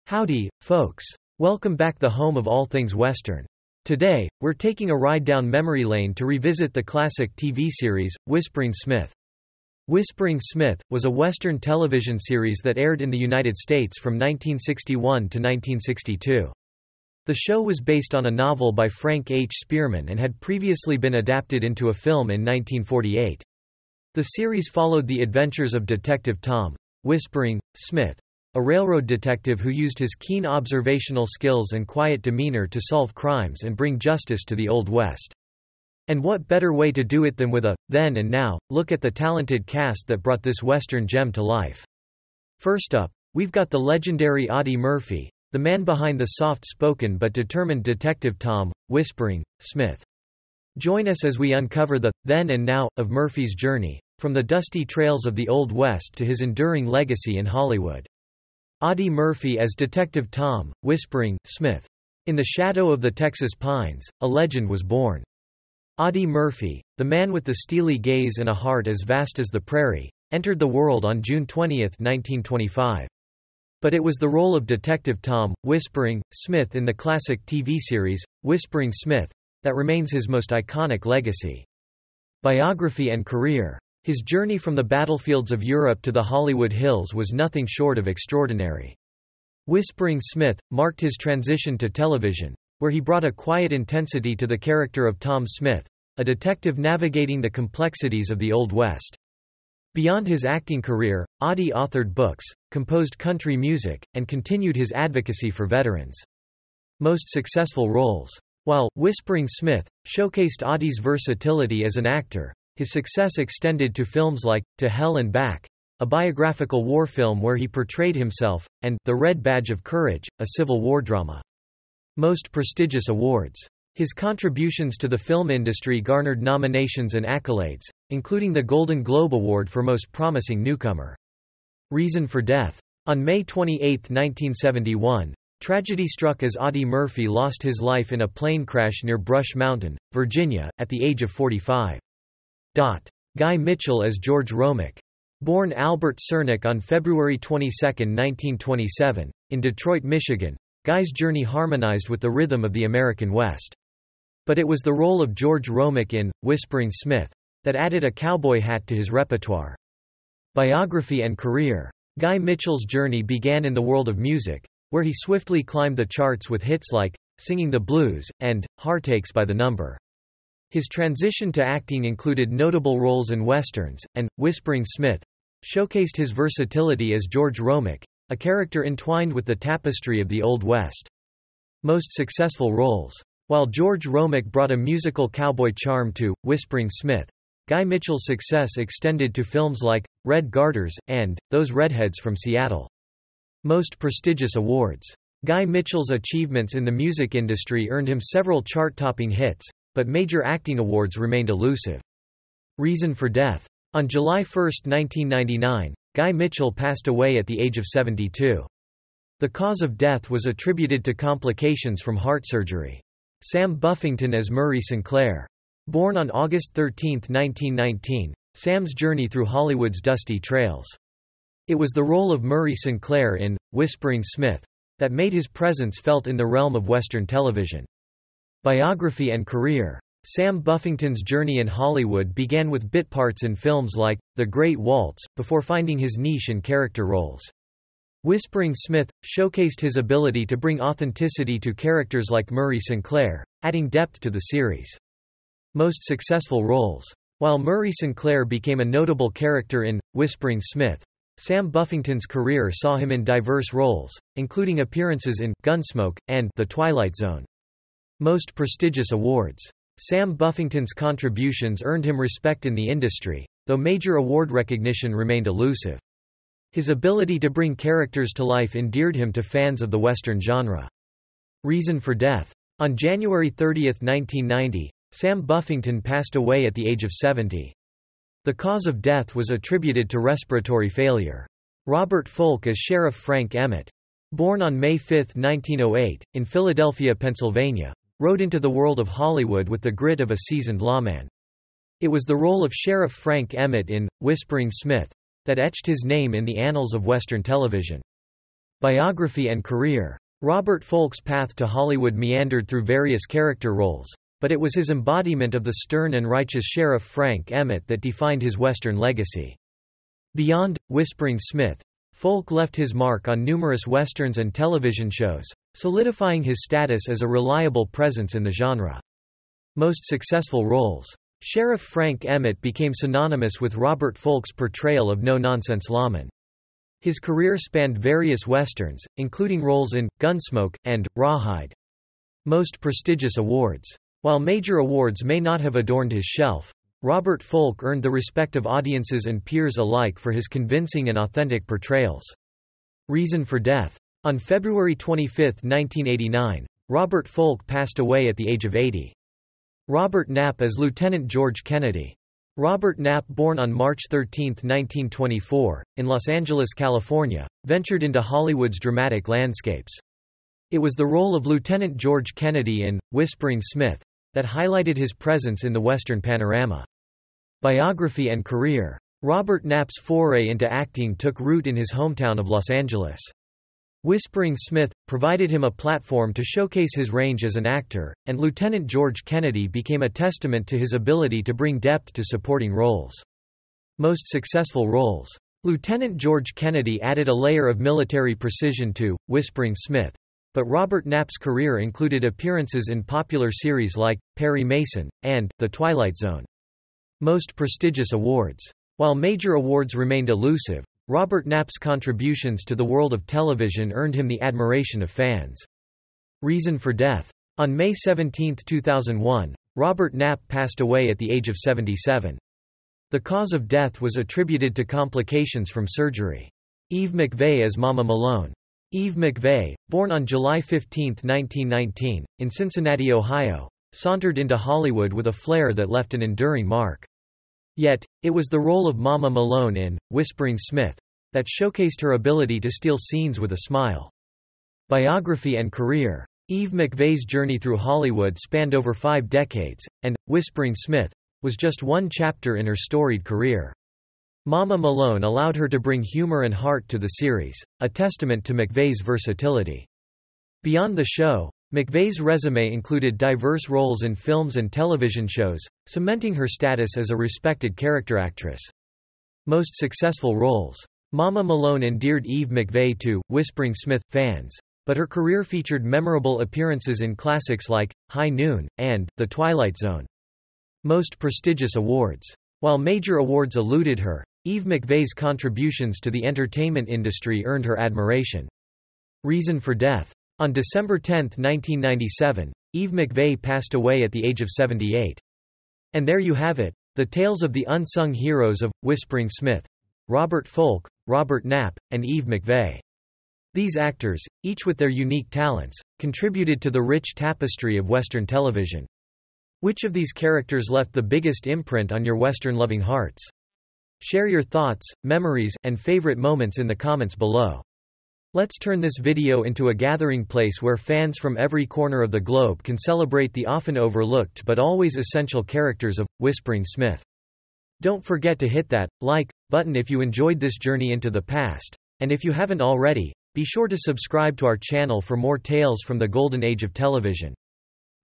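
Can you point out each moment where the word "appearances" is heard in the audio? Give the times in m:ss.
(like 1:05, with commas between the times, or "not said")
4:14, 6:32, 7:46.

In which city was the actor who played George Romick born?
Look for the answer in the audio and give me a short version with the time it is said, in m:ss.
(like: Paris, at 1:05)
Detroit, at 2:29.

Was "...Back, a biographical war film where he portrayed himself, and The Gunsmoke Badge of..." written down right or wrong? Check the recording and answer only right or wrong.
wrong.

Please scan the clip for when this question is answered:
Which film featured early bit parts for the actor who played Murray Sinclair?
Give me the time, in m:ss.
3:54.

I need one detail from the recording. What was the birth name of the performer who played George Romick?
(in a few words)
Albert Cernik.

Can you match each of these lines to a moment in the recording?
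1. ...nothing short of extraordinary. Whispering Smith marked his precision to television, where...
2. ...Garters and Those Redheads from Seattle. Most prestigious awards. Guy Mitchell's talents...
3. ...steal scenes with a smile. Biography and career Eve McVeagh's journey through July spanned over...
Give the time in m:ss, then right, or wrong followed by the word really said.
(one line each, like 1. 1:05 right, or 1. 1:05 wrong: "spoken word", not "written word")
1. 1:27 wrong: "transition", not "precision"
2. 3:10 wrong: "achievements", not "talents"
3. 7:12 wrong: "Hollywood", not "July".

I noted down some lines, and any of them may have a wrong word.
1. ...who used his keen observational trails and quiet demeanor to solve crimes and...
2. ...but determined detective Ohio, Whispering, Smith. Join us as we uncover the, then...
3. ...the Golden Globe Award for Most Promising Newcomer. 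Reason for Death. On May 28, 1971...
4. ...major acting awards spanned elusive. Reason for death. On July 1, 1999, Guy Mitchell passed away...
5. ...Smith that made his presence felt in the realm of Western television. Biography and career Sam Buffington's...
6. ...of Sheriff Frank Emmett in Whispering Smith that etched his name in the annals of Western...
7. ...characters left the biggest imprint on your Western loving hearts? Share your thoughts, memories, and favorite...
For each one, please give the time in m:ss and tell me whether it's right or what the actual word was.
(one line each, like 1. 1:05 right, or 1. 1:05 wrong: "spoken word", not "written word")
1. 0:29 wrong: "skills", not "trails"
2. 0:47 wrong: "Tom", not "Ohio"
3. 2:08 right
4. 3:20 wrong: "remained", not "spanned"
5. 3:44 right
6. 4:52 right
7. 8:20 right.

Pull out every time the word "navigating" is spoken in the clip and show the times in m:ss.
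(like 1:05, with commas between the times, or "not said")
1:36.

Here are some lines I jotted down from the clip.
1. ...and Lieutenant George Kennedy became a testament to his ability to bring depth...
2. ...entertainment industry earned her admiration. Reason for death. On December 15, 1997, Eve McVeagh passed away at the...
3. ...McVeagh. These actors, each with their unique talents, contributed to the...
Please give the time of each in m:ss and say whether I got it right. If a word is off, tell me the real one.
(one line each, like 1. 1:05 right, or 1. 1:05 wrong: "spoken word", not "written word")
1. 6:18 right
2. 7:56 wrong: "10", not "15"
3. 8:12 right.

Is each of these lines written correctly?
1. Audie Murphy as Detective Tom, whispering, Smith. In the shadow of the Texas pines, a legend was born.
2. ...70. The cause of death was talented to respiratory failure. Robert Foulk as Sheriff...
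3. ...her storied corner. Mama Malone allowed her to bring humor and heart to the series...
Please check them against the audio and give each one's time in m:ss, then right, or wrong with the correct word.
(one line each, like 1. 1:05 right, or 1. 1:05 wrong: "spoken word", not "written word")
1. 0:58 right
2. 4:37 wrong: "attributed", not "talented"
3. 7:22 wrong: "career", not "corner".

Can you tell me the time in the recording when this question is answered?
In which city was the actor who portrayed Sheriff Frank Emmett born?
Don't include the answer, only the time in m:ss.
4:46.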